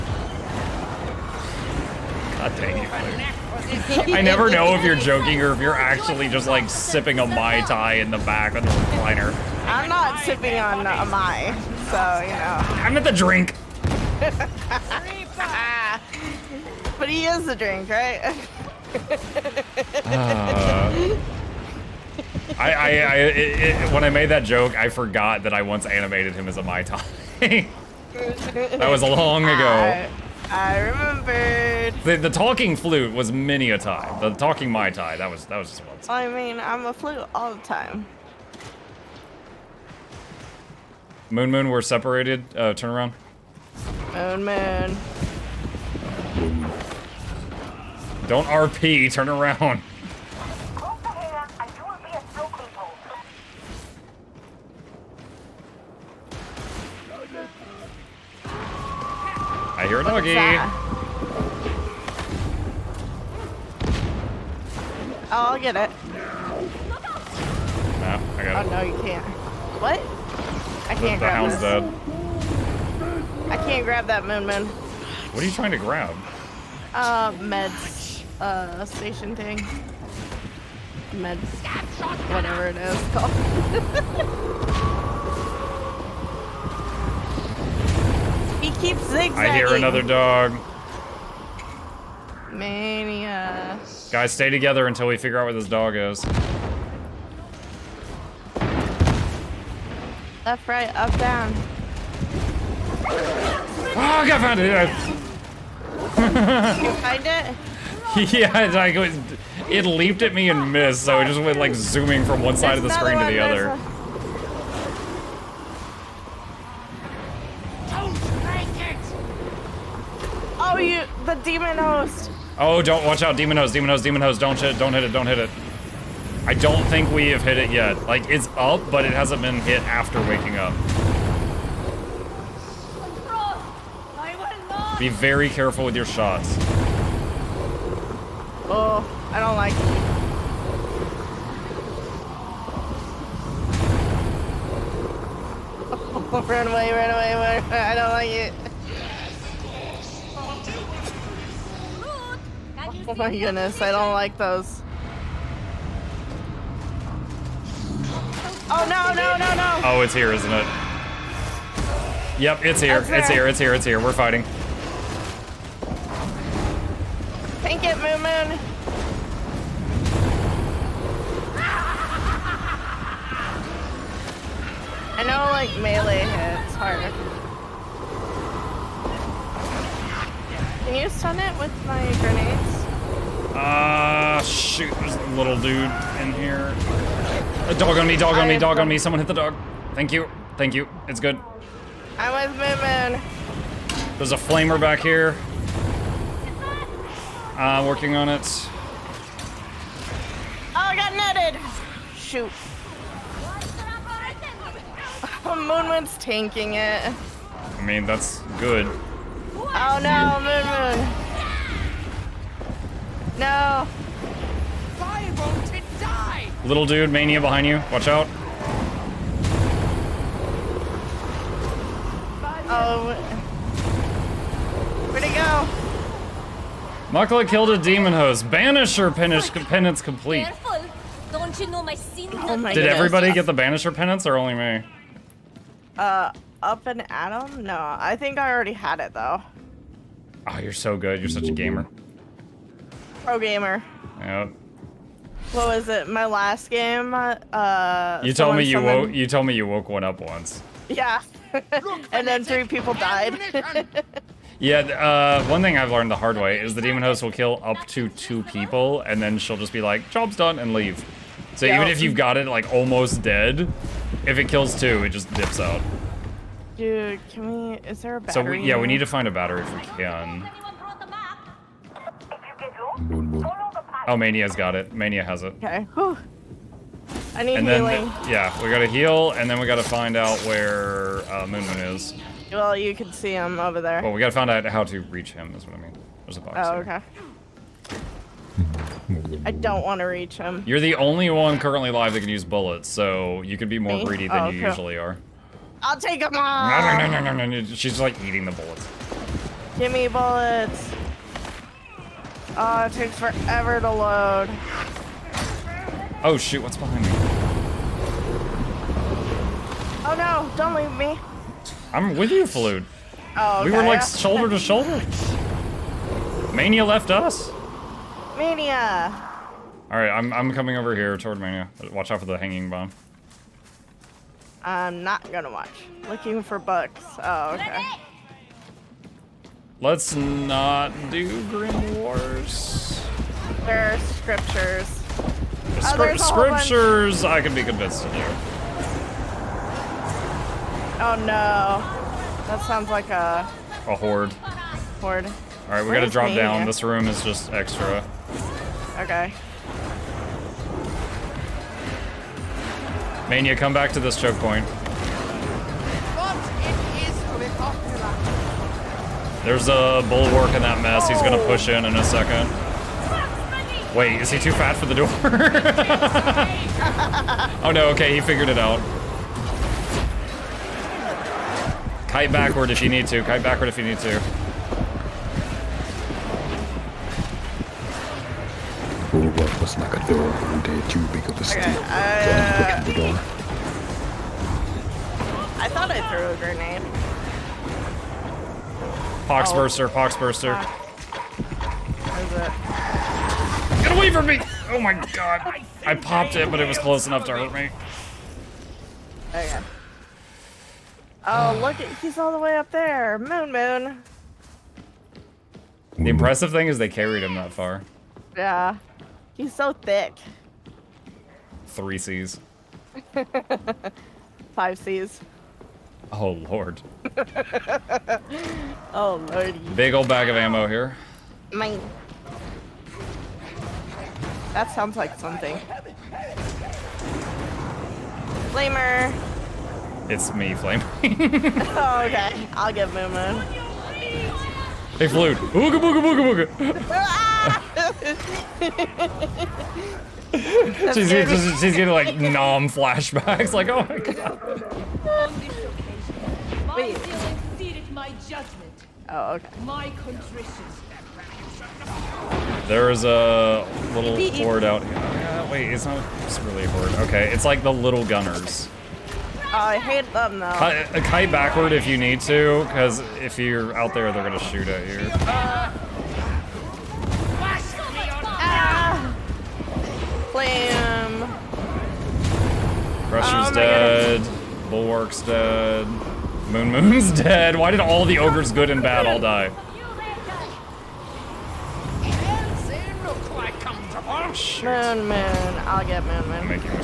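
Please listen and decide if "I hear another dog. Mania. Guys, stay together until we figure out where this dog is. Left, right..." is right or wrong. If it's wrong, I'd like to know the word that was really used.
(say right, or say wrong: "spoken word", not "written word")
right.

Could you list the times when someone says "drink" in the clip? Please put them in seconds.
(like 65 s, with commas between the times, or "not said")
13 s, 17 s.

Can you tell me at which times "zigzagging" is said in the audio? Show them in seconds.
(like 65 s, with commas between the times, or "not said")
89 s.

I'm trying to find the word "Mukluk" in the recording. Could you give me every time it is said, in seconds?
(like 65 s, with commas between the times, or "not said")
227 s.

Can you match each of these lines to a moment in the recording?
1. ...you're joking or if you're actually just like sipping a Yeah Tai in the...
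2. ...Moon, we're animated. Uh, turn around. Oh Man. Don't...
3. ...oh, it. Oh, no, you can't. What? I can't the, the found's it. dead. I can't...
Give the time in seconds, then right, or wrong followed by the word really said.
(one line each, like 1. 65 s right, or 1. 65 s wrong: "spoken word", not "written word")
1. 4 s wrong: "Mai", not "Yeah"
2. 41 s wrong: "separated", not "animated"
3. 68 s wrong: "hound", not "found".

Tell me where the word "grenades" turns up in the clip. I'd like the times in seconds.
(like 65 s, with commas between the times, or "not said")
182 s, 386 s.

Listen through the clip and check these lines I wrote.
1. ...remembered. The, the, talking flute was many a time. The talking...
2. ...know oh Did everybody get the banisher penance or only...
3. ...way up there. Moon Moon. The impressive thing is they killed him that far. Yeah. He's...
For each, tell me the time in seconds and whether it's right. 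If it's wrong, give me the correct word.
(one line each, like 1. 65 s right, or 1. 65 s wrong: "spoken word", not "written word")
1. 30 s right
2. 231 s right
3. 402 s wrong: "carried", not "killed".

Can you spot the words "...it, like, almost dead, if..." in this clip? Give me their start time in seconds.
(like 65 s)
262 s.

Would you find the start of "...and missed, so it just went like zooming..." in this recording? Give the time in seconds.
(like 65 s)
110 s.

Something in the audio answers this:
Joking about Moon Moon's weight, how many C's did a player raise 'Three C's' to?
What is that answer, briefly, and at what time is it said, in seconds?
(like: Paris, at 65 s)
Five, at 414 s.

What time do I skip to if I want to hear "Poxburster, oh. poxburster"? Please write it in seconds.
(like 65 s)
389 s.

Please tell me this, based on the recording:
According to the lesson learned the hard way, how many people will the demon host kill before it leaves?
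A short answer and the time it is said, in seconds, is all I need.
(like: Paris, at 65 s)
2, at 258 s.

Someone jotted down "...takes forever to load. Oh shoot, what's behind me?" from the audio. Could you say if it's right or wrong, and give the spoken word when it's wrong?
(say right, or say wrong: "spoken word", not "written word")
right.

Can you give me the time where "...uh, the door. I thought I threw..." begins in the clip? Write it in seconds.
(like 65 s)
381 s.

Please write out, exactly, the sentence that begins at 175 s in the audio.
I know, like, melee hits hard.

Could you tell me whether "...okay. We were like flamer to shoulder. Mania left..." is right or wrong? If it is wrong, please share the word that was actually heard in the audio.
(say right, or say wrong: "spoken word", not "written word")
wrong: "shoulder", not "flamer".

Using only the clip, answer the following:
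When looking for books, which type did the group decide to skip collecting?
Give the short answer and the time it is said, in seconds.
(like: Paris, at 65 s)
Grimoires, at 331 s.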